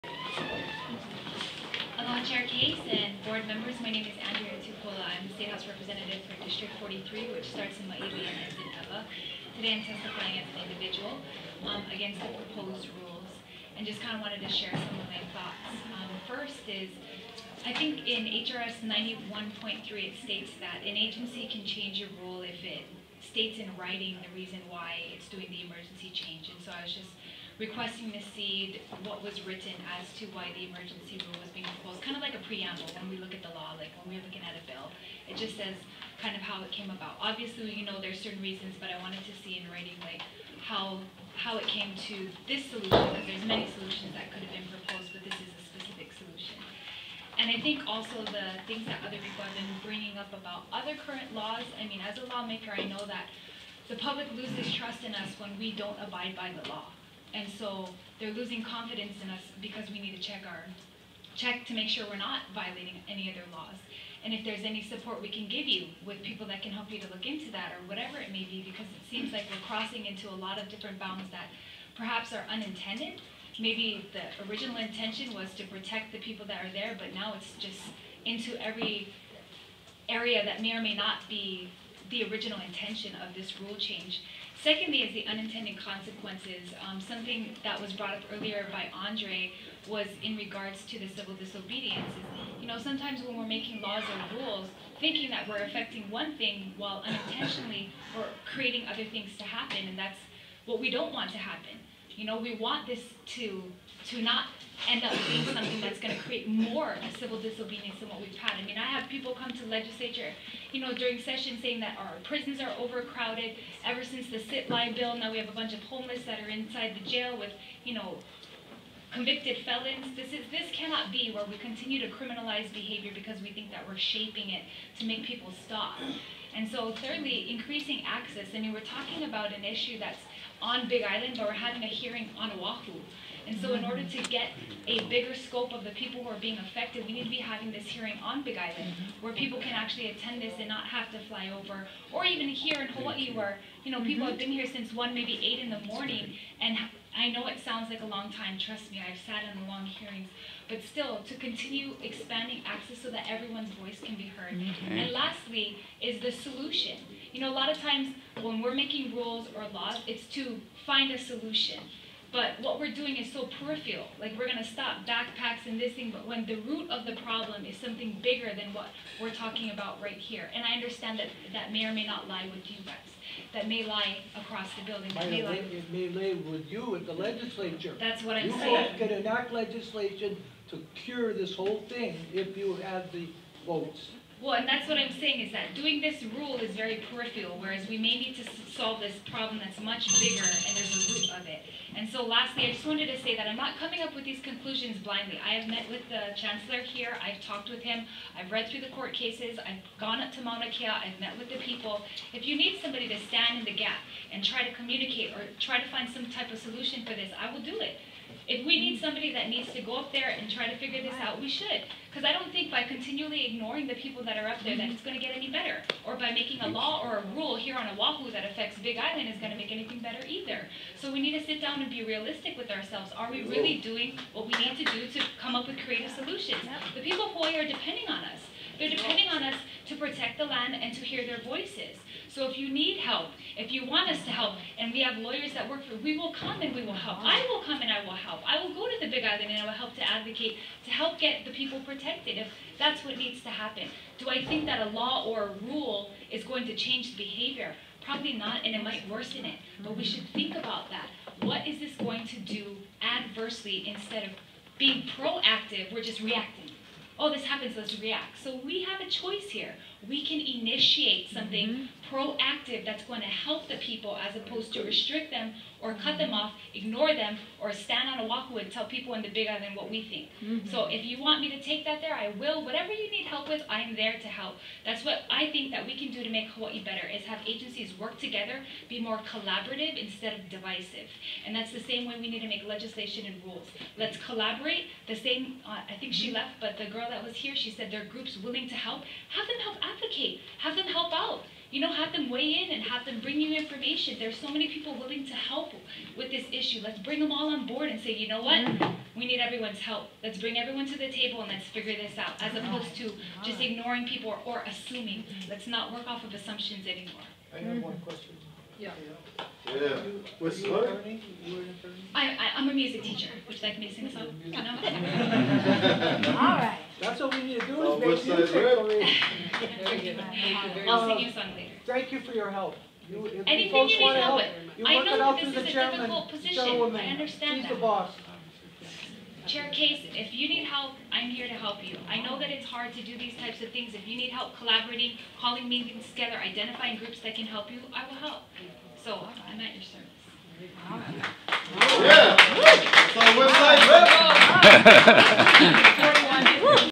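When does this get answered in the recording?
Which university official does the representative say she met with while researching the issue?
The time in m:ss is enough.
3:16.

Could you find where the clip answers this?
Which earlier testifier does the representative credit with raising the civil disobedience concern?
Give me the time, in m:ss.
1:28.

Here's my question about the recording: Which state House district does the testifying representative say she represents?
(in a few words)
43.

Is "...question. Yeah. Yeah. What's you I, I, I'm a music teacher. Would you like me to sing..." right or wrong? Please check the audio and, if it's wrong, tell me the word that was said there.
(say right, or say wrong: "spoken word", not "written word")
right.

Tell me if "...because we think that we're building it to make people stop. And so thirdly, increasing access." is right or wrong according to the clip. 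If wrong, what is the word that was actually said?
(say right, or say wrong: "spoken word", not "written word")
wrong: "shaping", not "building".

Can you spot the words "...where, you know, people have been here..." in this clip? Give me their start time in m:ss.
2:23.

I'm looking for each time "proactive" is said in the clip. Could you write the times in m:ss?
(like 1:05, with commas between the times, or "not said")
4:15, 4:22.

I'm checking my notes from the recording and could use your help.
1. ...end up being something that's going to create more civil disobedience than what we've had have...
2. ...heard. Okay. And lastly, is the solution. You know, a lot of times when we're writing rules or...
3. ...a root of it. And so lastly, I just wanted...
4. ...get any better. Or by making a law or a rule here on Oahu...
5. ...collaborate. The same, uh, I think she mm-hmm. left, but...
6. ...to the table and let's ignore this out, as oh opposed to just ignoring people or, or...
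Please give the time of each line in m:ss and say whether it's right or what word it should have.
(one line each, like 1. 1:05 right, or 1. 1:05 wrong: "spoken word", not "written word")
1. 1:44 right
2. 2:34 wrong: "making", not "writing"
3. 3:10 right
4. 3:35 right
5. 4:44 right
6. 5:00 wrong: "figure", not "ignore".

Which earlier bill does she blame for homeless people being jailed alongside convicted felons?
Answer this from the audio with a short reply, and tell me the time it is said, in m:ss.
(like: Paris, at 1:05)
sit lie bill, at 1:54.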